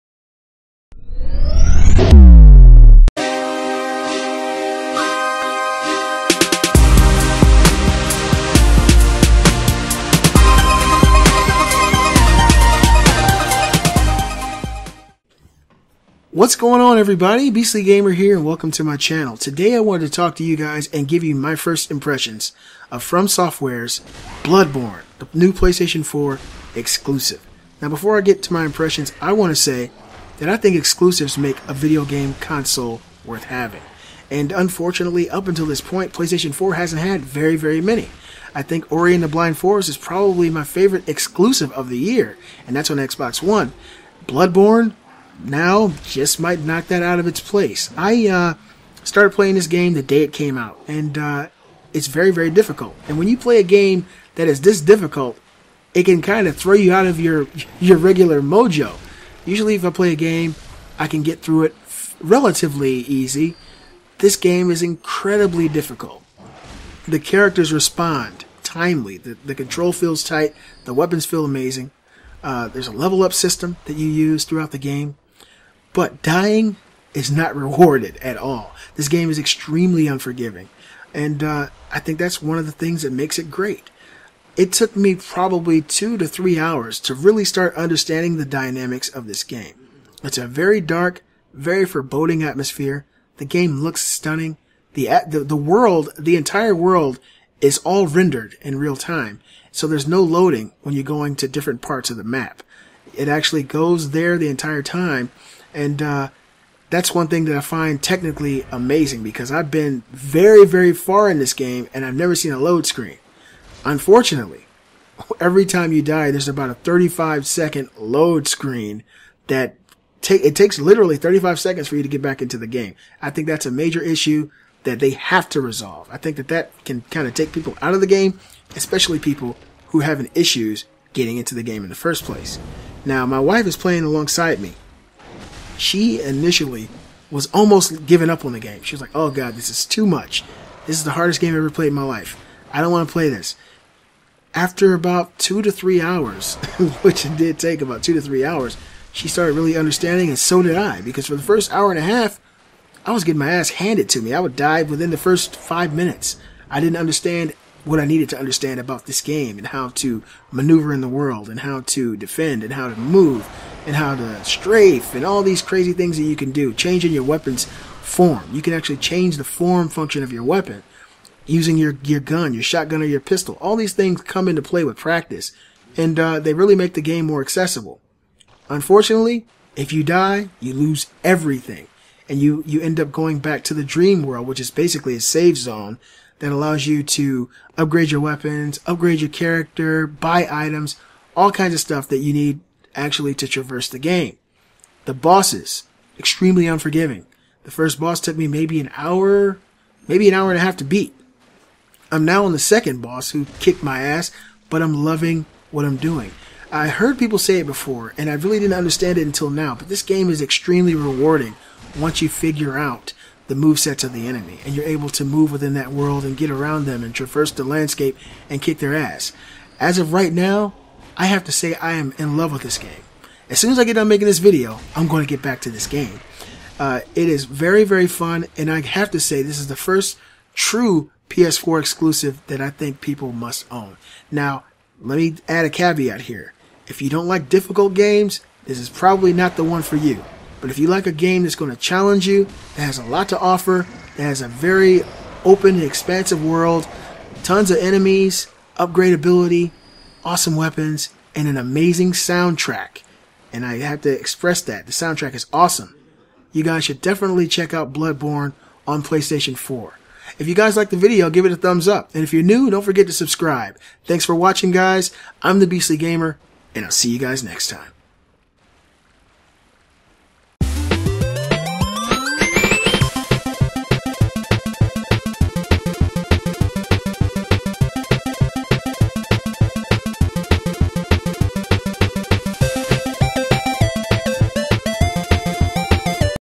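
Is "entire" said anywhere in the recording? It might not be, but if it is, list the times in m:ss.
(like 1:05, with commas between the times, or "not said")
1:36, 1:44.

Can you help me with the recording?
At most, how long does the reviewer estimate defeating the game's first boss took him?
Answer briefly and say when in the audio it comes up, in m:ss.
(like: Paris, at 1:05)
an hour and a half, at 3:20.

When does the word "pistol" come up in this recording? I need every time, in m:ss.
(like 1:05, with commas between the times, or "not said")
2:53.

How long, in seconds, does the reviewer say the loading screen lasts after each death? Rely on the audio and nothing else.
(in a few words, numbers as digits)
35.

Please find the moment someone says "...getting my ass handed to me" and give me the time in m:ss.
2:33.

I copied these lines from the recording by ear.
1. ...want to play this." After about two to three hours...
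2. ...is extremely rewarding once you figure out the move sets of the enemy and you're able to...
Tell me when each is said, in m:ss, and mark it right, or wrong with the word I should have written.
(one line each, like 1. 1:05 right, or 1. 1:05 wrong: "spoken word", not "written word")
1. 2:22 right
2. 3:30 right.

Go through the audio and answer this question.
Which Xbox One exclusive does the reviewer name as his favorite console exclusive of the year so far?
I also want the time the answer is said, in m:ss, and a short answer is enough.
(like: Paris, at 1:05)
Ori and the Blind Forest, at 0:38.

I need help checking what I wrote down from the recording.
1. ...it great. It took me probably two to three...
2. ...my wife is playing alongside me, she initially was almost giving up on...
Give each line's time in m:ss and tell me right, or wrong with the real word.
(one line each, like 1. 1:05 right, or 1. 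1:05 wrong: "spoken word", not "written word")
1. 1:23 right
2. 2:13 right.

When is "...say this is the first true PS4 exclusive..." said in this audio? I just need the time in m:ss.
3:49.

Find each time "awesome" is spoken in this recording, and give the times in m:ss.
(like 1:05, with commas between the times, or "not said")
4:10, 4:15.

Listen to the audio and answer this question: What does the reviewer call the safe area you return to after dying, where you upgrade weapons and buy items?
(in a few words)
the dream world.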